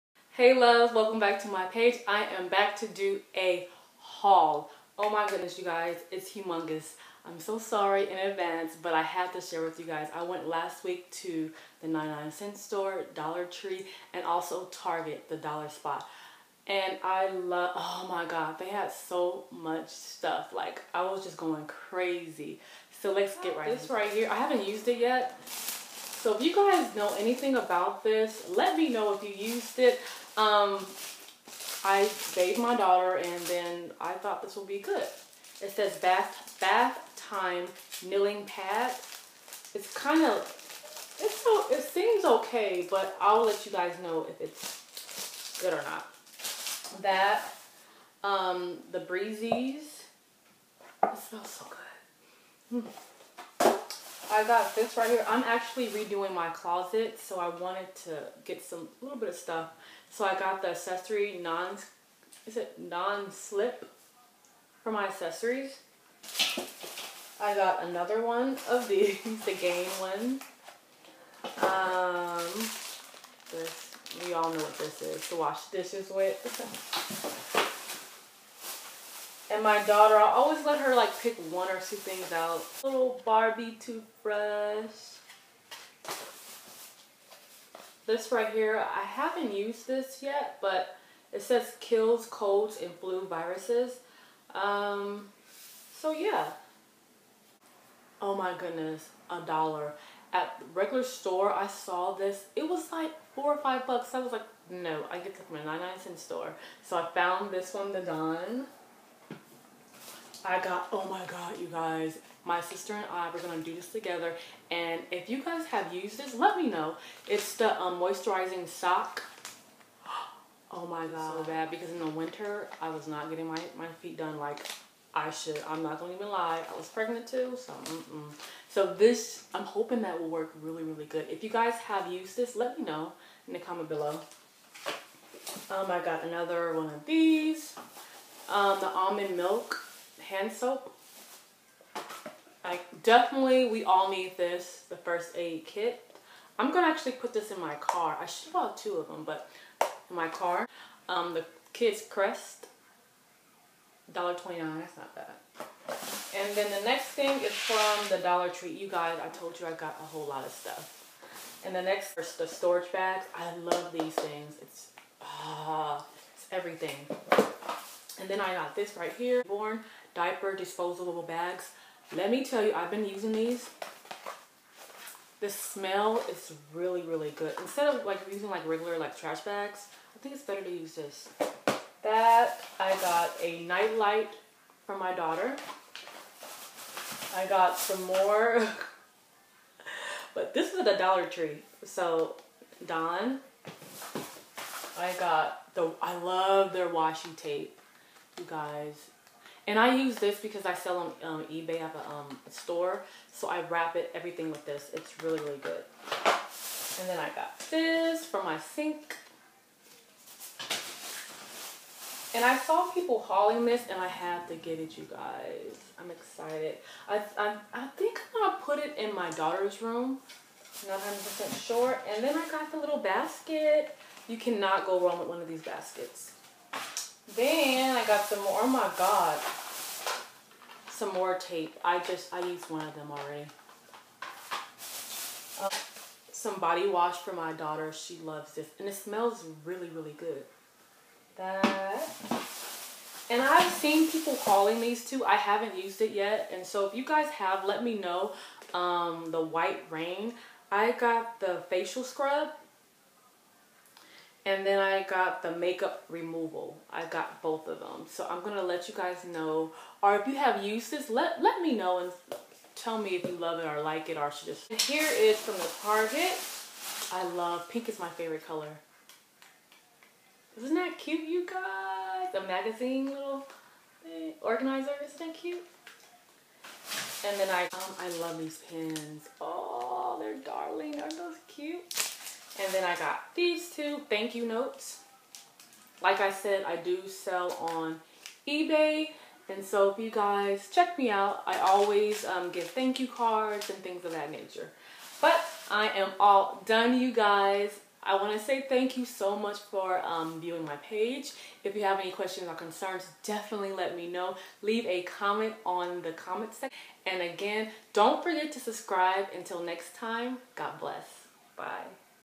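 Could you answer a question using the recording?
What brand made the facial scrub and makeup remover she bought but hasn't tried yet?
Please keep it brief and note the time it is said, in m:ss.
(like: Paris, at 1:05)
White Rain, at 4:09.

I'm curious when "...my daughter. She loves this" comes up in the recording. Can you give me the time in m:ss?
3:57.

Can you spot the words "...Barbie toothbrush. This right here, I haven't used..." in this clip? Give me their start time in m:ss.
1:23.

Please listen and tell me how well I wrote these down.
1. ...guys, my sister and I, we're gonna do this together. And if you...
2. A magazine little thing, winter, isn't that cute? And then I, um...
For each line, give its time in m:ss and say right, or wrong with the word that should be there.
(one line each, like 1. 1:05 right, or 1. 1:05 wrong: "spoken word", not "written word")
1. 1:51 right
2. 4:32 wrong: "organizer", not "winter".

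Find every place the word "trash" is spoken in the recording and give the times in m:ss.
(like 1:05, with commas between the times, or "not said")
2:59.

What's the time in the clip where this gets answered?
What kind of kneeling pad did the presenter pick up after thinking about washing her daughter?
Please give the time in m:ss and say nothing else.
0:36.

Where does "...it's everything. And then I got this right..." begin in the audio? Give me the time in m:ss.
2:46.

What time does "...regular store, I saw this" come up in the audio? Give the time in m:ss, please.
1:40.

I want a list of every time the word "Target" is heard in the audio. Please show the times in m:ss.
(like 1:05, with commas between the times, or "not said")
0:14, 4:25.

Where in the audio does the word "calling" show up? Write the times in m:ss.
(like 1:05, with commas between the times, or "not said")
4:04.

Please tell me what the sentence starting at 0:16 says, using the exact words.
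And I love, oh my God, they had so much stuff.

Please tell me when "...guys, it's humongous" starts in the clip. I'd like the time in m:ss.
0:05.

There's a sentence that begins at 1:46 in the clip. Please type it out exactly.
So I found this one, the Dawn.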